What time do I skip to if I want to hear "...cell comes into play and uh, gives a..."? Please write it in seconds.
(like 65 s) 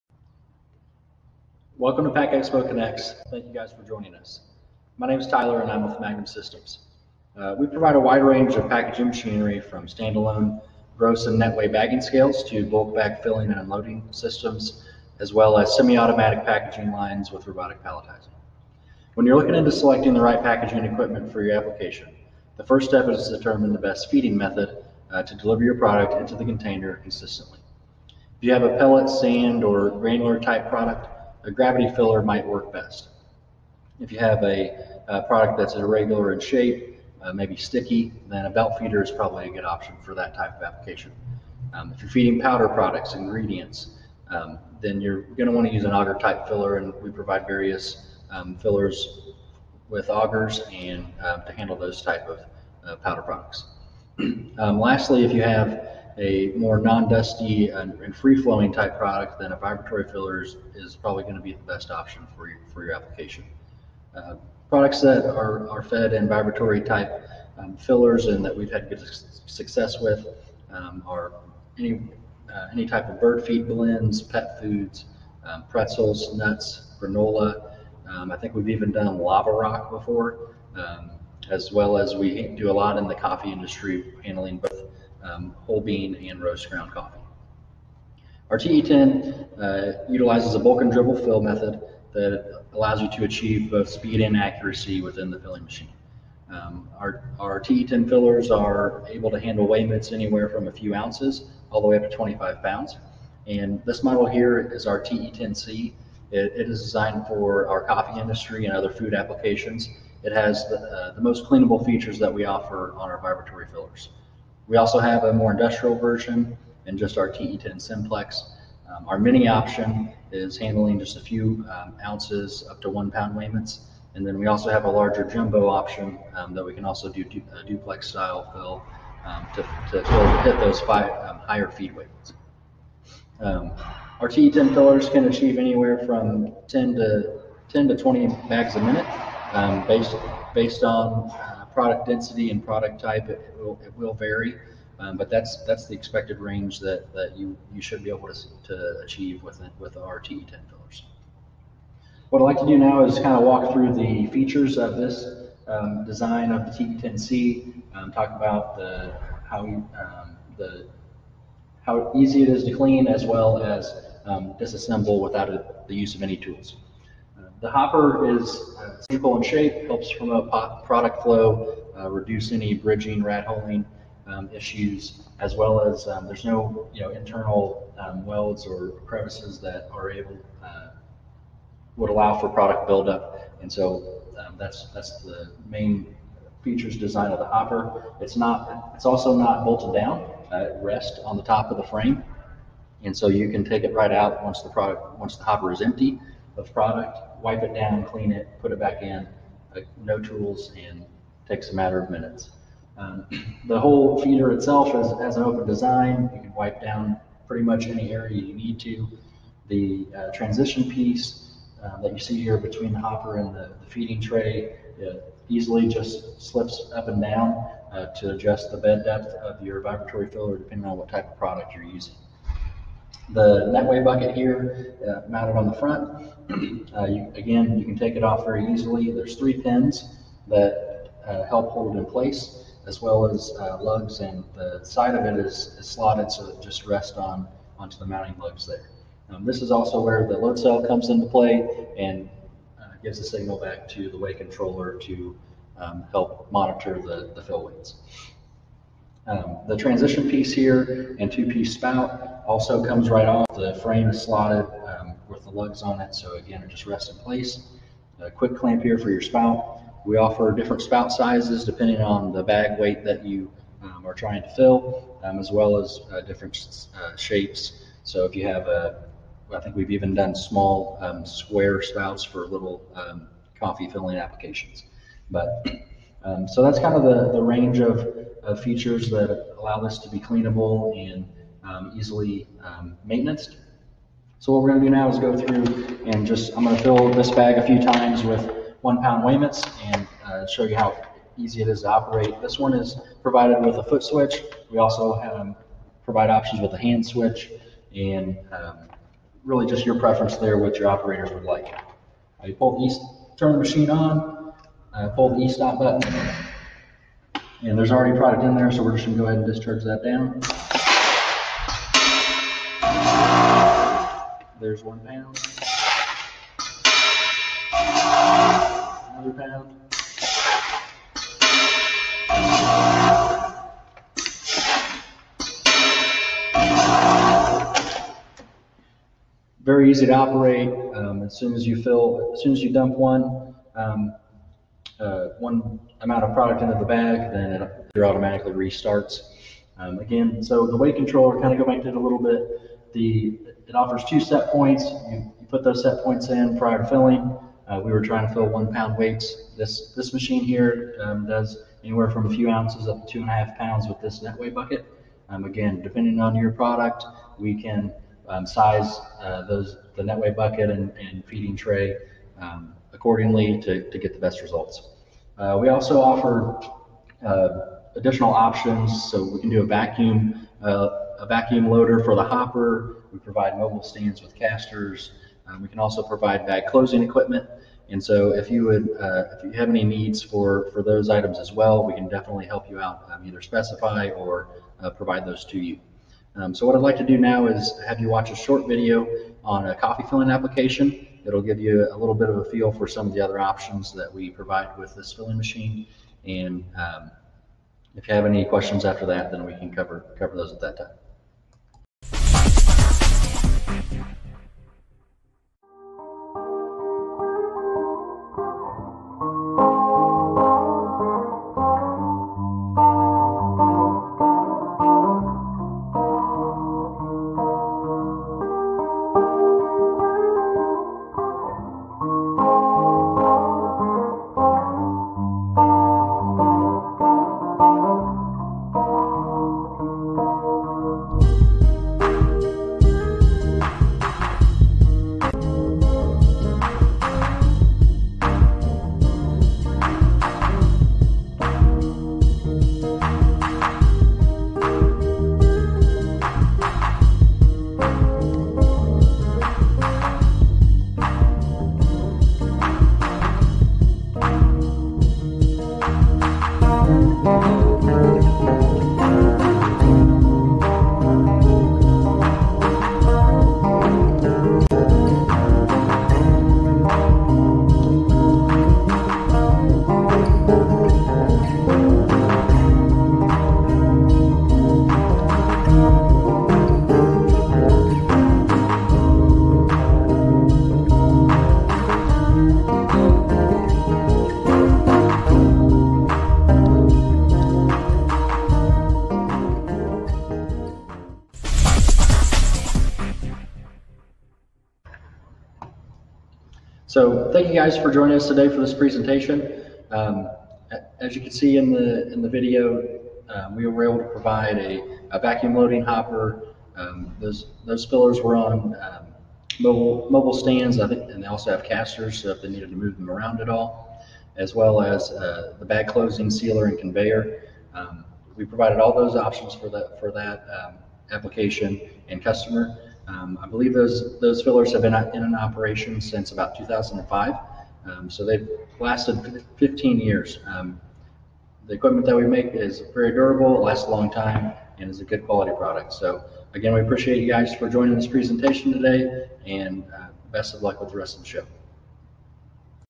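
240 s.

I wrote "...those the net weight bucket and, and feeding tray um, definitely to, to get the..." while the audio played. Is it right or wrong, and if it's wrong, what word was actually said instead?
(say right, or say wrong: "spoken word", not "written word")
wrong: "accordingly", not "definitely".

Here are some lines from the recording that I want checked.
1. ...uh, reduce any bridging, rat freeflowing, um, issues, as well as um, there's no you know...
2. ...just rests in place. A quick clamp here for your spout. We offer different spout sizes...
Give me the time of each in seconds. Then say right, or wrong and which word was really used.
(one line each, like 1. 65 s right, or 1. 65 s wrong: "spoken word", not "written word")
1. 171 s wrong: "holing", not "freeflowing"
2. 256 s right.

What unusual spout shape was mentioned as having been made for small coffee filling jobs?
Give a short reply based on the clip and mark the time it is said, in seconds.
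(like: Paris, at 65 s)
square, at 271 s.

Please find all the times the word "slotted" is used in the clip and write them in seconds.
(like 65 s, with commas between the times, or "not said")
235 s, 254 s.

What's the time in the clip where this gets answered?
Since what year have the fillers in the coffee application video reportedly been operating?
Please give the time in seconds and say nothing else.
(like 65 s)
526 s.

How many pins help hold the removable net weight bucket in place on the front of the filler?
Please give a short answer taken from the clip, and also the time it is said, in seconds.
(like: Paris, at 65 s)
3, at 229 s.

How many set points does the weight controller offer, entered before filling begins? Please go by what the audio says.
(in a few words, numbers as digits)
2.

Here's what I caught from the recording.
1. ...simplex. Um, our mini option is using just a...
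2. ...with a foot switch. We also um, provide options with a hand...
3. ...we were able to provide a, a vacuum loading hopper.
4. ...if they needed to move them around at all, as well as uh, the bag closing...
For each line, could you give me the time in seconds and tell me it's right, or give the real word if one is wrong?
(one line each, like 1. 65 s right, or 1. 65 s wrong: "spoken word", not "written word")
1. 117 s wrong: "handling", not "using"
2. 293 s right
3. 503 s right
4. 512 s right.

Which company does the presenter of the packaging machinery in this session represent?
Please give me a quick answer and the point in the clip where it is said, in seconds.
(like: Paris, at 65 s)
Magnum Systems, at 5 s.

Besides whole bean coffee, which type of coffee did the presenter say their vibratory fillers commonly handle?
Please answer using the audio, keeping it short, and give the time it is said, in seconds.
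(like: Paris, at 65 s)
roast ground, at 86 s.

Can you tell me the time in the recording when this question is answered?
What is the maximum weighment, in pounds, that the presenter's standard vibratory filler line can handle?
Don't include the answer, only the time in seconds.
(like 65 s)
102 s.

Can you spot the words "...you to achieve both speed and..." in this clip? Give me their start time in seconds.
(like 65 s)
93 s.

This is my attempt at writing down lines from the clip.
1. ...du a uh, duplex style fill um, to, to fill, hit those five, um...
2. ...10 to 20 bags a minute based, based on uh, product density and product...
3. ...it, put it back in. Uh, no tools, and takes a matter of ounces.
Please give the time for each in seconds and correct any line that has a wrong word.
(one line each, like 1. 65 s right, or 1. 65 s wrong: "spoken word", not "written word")
1. 127 s right
2. 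137 s right
3. 198 s wrong: "minutes", not "ounces".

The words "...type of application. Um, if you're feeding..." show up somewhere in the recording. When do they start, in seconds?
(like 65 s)
40 s.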